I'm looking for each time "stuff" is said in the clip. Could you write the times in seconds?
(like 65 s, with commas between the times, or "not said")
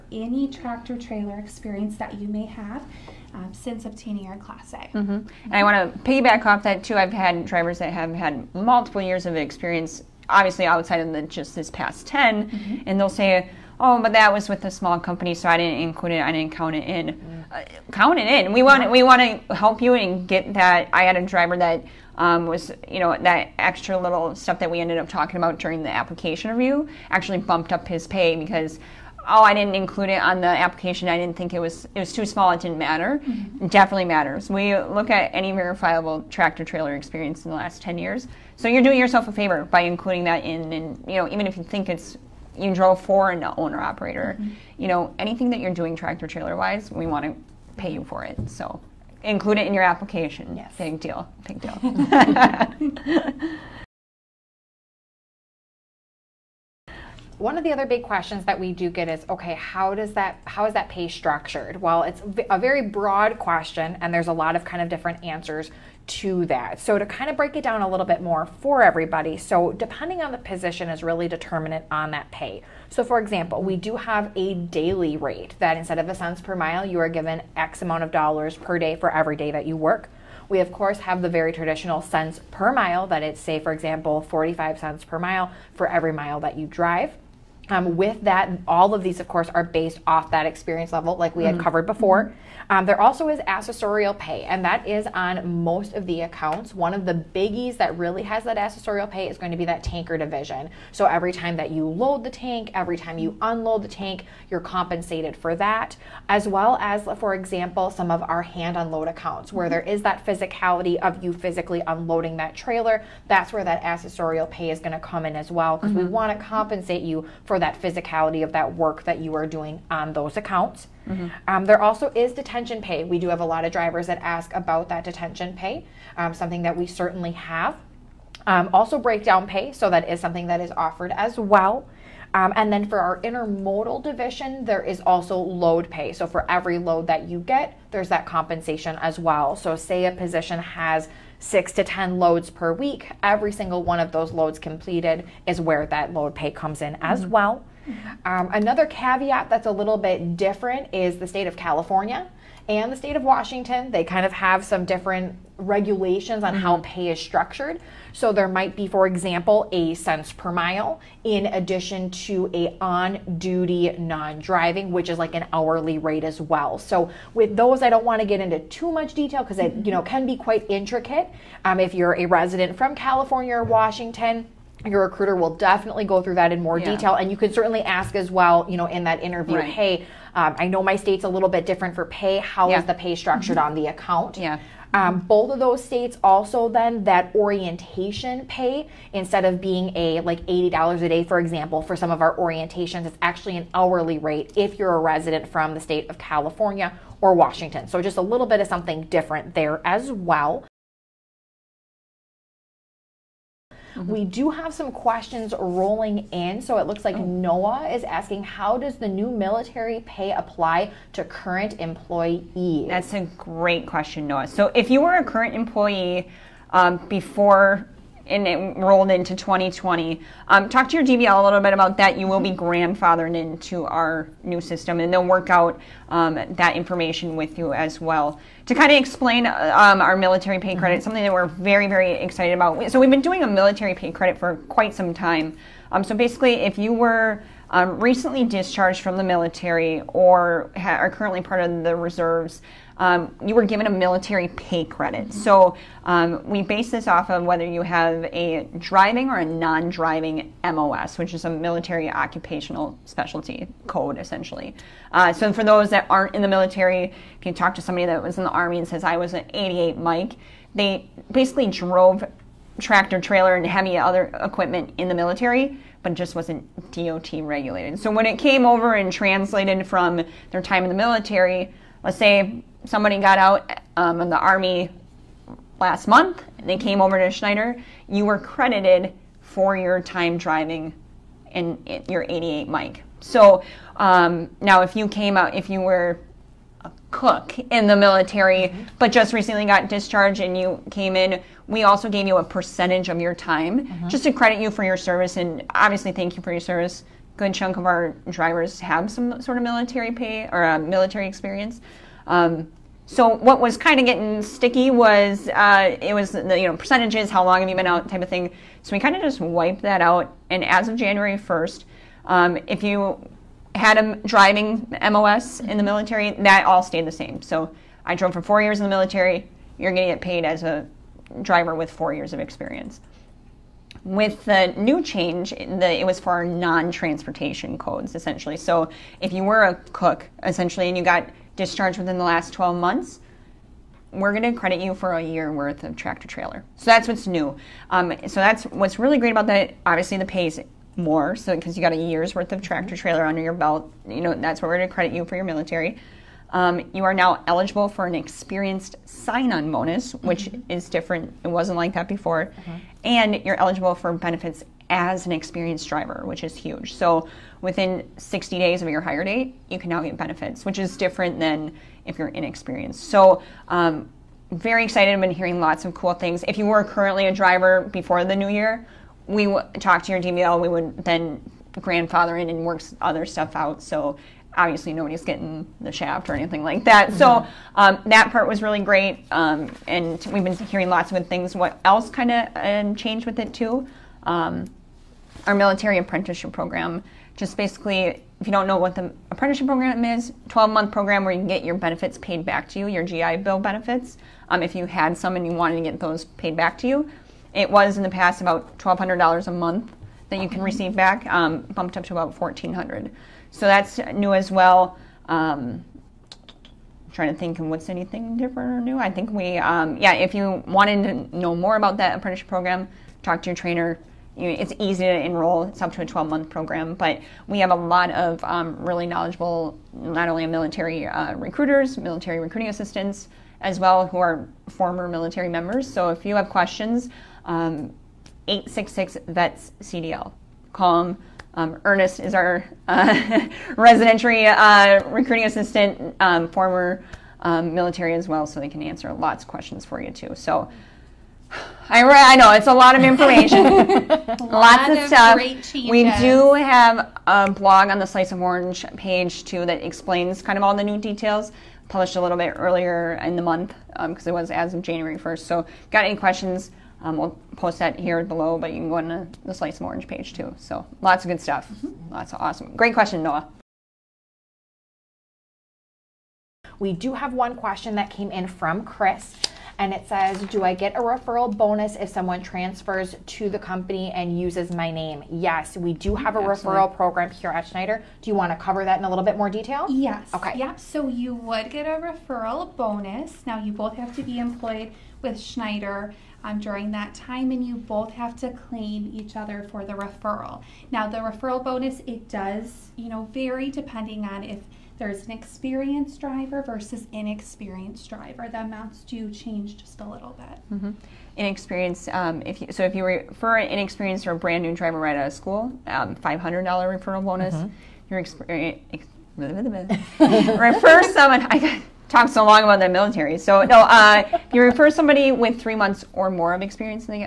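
24 s, 373 s, 445 s, 461 s.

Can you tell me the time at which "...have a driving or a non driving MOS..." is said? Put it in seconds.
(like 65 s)
247 s.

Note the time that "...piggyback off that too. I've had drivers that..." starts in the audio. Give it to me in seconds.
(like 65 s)
6 s.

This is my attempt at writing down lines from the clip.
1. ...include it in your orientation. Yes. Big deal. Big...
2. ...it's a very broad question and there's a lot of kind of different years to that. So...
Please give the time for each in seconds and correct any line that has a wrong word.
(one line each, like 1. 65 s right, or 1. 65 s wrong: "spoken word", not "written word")
1. 49 s wrong: "application", not "orientation"
2. 62 s wrong: "answers", not "years".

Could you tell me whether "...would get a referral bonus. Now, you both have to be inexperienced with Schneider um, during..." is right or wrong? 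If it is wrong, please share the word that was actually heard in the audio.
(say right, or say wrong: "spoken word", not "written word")
wrong: "employed", not "inexperienced".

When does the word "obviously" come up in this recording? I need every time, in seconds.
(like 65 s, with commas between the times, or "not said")
10 s, 295 s, 339 s, 374 s.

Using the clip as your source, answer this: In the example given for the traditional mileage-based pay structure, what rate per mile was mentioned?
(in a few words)
45 cents.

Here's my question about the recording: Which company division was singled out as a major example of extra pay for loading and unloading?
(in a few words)
tanker division.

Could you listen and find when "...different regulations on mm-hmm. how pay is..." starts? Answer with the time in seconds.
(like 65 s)
154 s.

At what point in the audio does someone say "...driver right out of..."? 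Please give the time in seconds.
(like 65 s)
504 s.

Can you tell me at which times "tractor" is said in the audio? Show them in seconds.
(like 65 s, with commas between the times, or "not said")
0 s, 36 s, 45 s, 262 s, 335 s, 342 s.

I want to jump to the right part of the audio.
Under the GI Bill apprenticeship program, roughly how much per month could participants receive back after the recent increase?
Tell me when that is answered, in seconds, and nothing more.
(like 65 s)
402 s.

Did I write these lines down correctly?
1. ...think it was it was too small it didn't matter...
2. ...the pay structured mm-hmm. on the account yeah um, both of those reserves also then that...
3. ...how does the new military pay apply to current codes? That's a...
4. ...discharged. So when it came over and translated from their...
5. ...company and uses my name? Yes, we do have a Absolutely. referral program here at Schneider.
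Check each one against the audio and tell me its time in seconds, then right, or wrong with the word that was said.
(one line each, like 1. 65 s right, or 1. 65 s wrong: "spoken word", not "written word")
1. 31 s right
2. 182 s wrong: "states", not "reserves"
3. 208 s wrong: "employees", not "codes"
4. 267 s wrong: "regulated", not "discharged"
5. 473 s right.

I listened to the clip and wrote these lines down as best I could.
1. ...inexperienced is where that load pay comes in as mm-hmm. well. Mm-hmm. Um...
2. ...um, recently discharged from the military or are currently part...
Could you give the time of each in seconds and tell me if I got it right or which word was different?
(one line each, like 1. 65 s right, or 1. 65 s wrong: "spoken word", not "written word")
1. 144 s wrong: "completed", not "inexperienced"
2. 237 s right.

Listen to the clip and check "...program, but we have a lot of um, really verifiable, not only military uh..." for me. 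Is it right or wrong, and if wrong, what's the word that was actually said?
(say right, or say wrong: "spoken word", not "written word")
wrong: "knowledgeable", not "verifiable".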